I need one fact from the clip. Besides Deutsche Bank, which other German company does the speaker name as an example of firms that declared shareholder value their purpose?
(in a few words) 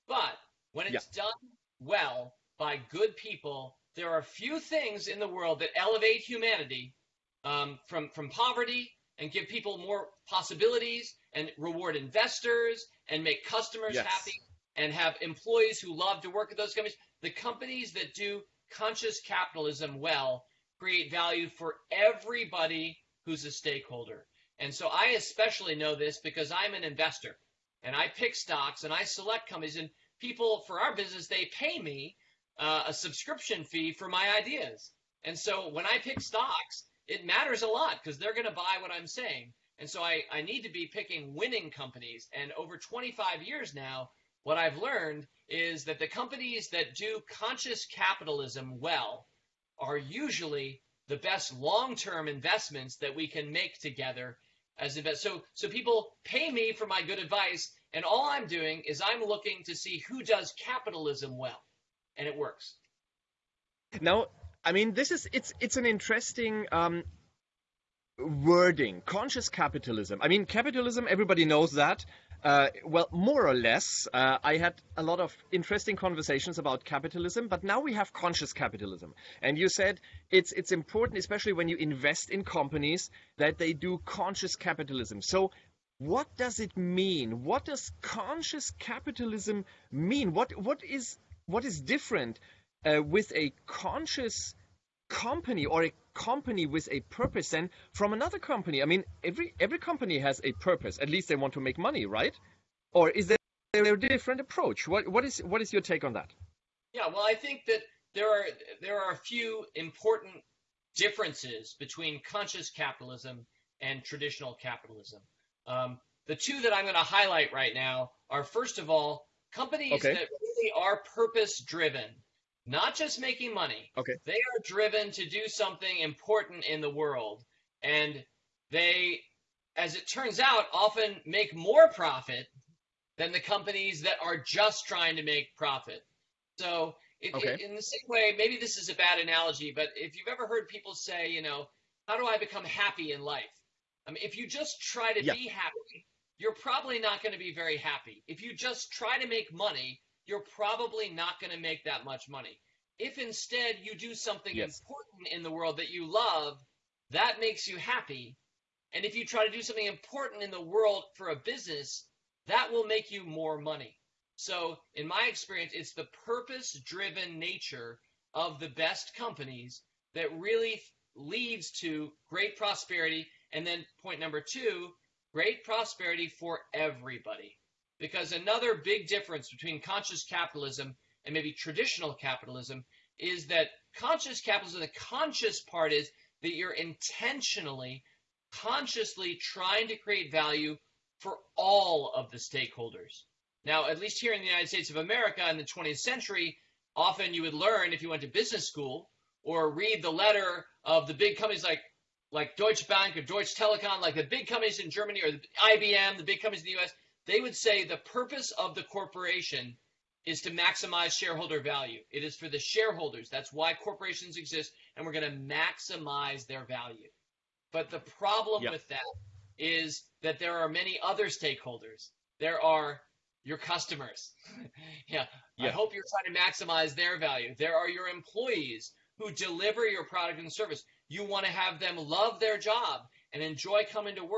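Deutsche Telekom.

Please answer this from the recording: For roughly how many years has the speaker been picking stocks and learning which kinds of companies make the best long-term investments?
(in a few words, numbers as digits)
25 years.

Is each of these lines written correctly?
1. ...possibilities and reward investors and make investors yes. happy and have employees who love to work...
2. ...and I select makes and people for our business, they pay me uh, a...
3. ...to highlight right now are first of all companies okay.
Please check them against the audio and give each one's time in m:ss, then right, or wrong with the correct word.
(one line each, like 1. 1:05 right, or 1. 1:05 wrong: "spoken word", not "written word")
1. 0:10 wrong: "customers", not "investors"
2. 0:28 wrong: "companies", not "makes"
3. 1:57 right.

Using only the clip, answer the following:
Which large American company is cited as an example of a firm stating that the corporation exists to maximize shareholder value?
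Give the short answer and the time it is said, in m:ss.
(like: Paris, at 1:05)
IBM, at 3:25.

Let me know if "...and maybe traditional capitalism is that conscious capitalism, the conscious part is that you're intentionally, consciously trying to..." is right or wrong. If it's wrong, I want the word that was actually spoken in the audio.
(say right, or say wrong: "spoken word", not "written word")
right.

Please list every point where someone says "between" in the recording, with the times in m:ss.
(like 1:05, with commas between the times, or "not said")
1:51, 2:59.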